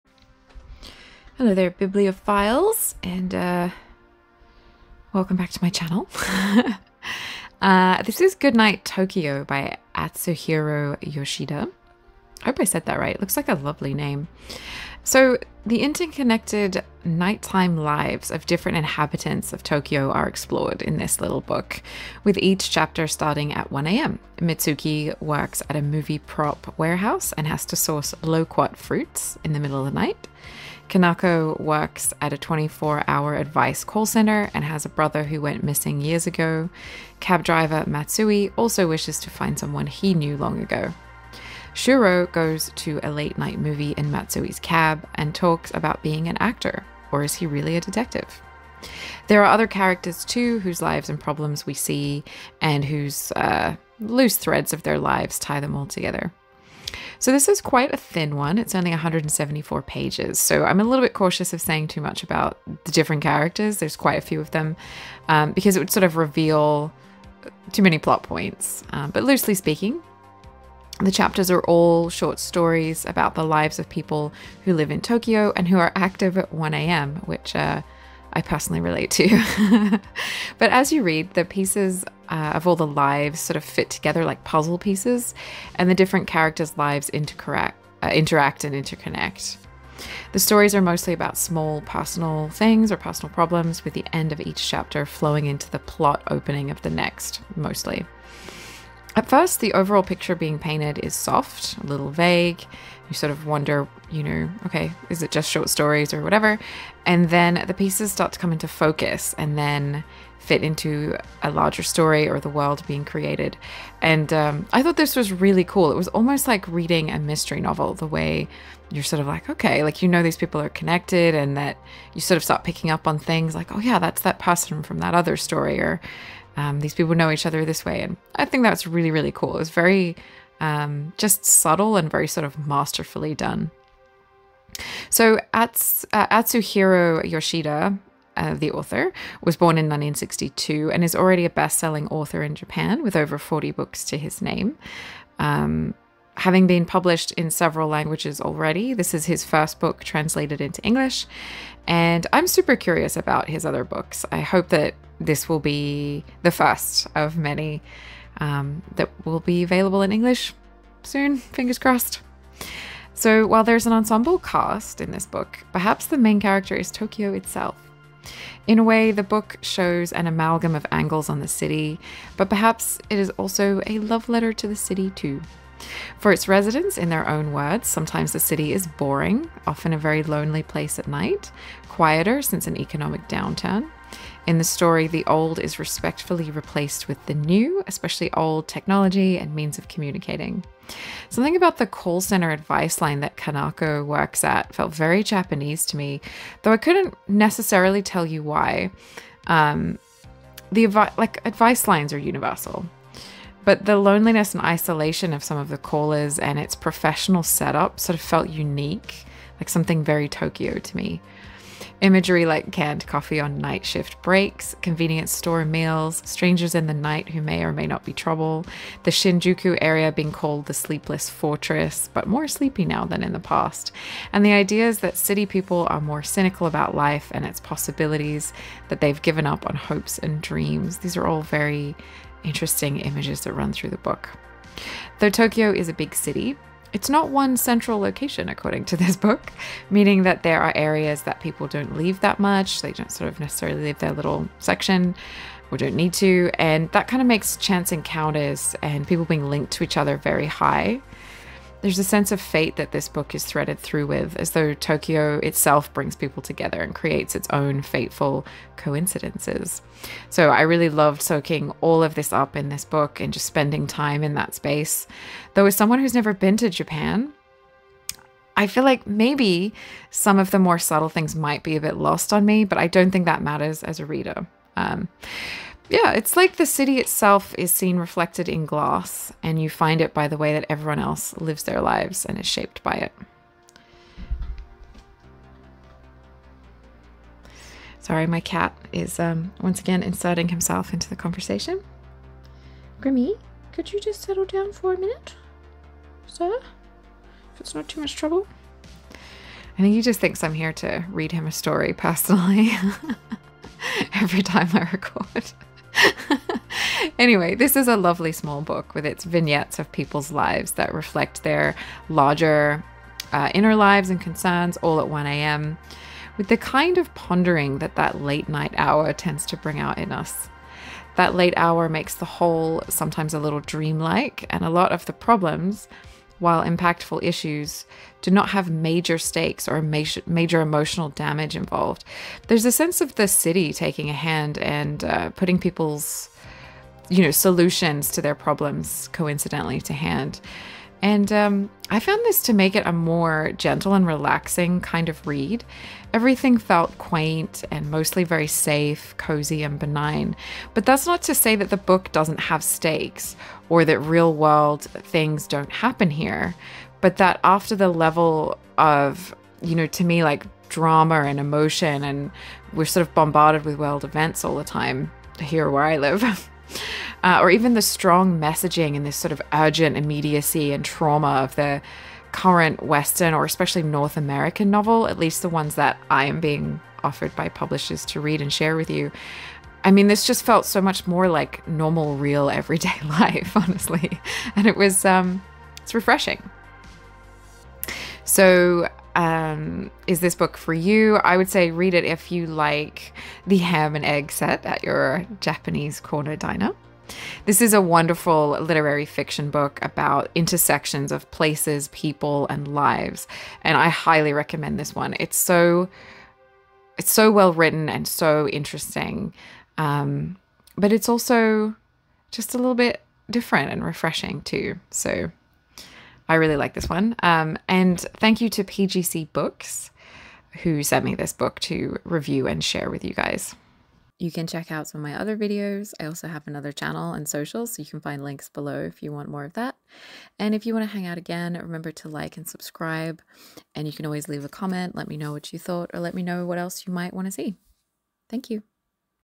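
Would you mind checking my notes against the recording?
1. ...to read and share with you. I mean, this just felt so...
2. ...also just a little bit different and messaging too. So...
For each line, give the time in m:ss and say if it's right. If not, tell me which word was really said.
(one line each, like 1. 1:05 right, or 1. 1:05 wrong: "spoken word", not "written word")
1. 6:18 right
2. 6:51 wrong: "refreshing", not "messaging".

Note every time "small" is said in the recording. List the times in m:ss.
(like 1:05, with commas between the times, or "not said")
1:31, 5:08.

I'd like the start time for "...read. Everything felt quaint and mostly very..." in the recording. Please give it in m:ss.
5:45.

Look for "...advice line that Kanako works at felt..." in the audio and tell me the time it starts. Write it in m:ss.
3:12.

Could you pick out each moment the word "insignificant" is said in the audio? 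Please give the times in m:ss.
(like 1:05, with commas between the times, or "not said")
not said.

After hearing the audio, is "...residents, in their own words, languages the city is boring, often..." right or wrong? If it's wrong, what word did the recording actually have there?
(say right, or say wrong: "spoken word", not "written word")
wrong: "sometimes", not "languages".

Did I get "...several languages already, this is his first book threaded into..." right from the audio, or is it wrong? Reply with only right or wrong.
wrong.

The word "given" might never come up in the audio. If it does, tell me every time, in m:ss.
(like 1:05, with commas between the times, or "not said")
3:49.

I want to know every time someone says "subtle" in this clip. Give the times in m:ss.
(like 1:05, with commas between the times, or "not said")
2:11, 4:30.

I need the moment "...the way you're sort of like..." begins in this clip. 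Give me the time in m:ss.
1:57.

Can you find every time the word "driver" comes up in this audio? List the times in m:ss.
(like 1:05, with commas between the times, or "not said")
0:37.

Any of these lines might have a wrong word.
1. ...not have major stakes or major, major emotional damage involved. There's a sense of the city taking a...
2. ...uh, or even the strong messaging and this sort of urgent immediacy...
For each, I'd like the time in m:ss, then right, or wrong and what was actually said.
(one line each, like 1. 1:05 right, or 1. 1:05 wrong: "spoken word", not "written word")
1. 5:28 right
2. 6:07 right.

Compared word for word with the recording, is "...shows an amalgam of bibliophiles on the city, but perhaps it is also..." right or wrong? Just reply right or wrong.
wrong.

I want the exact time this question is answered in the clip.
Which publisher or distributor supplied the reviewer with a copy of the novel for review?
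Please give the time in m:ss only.
6:58.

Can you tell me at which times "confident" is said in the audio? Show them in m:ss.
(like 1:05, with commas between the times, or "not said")
not said.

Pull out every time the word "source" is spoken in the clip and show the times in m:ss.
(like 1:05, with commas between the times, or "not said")
0:27.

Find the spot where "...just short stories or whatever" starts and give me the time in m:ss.
1:45.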